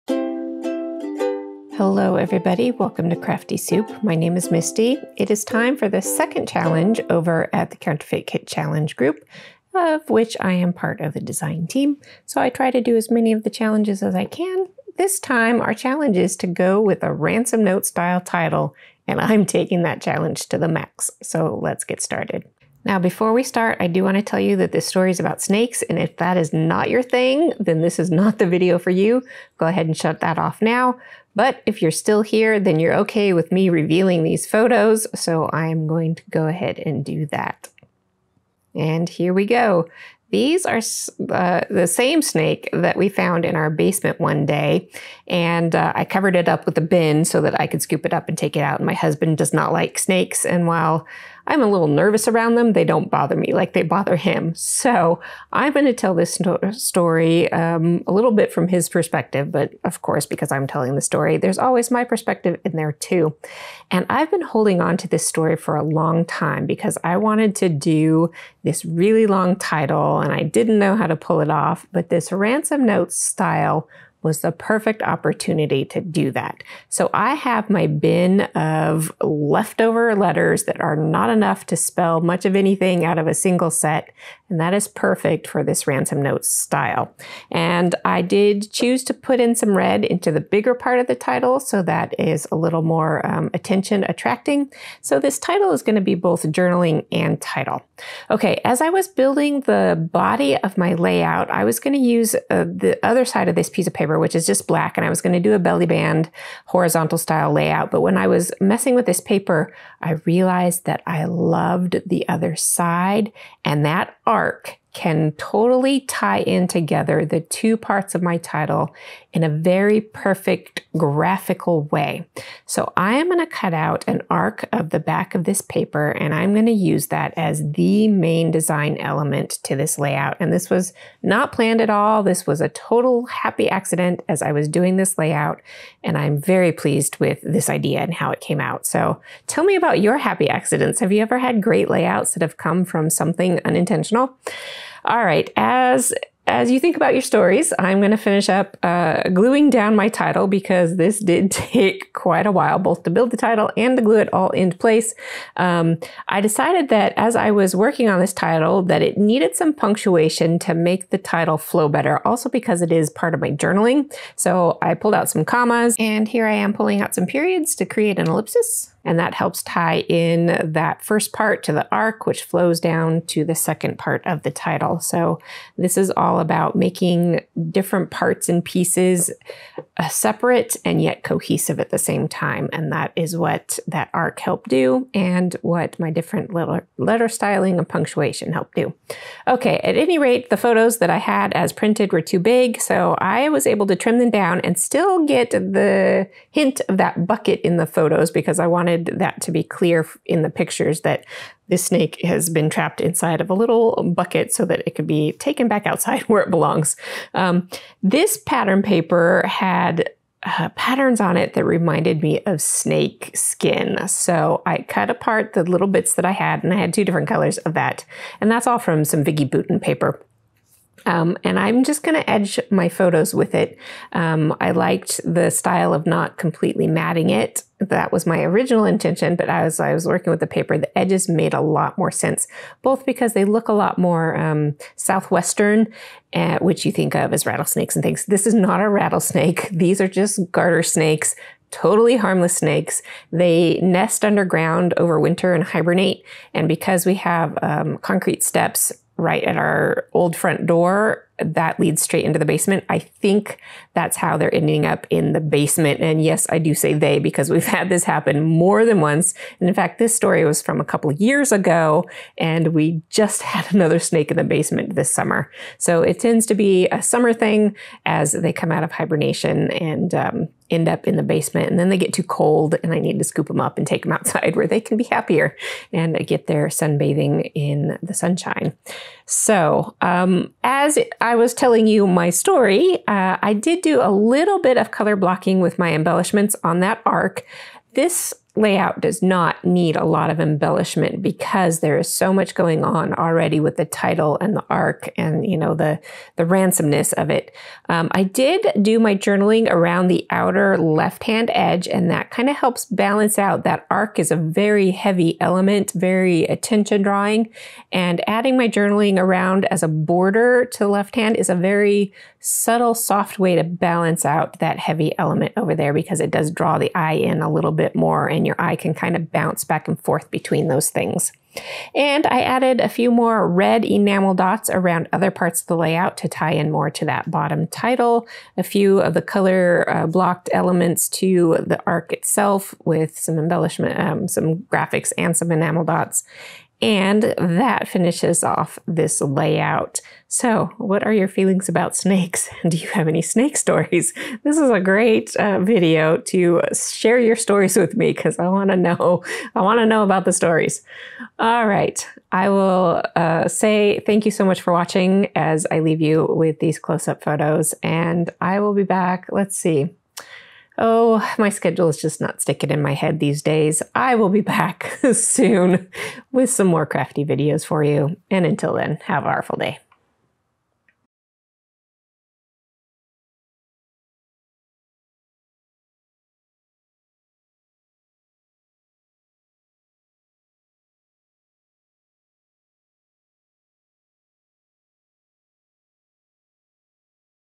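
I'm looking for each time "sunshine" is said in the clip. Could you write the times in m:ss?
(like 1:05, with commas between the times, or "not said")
4:38.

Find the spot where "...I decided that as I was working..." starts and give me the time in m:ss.
2:36.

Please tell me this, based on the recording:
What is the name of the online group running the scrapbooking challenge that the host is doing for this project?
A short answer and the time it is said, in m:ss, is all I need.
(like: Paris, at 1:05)
Counterfeit Kit Challenge, at 0:07.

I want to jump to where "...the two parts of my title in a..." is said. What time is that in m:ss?
1:57.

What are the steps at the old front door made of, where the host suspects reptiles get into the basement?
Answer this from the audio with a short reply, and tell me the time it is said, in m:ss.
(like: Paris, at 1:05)
Concrete, at 4:07.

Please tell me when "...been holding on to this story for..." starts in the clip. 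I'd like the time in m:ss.
1:04.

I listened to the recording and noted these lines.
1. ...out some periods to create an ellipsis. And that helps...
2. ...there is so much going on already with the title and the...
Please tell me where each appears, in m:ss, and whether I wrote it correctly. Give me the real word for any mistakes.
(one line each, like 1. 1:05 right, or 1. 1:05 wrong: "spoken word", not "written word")
1. 2:47 right
2. 4:51 right.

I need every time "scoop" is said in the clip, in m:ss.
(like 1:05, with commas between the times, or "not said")
0:47, 4:33.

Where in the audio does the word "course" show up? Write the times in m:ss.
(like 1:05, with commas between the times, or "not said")
1:00.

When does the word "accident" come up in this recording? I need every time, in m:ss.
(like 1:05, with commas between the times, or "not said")
2:13, 2:20.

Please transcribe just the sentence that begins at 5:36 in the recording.
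And that finishes off this layout.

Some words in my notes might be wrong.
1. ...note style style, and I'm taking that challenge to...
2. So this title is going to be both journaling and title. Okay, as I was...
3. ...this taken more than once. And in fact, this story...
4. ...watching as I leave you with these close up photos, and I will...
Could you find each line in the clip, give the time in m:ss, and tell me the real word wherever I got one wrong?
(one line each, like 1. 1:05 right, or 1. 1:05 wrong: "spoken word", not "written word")
1. 0:17 wrong: "title", not "style"
2. 1:35 right
3. 4:17 wrong: "happen", not "taken"
4. 5:54 right.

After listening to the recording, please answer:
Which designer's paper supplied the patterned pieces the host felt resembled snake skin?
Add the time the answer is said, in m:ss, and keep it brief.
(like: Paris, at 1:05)
Vicki Boutin, at 3:39.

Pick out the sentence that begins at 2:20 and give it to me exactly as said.
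Have you ever had great layouts that have come from something unintentional?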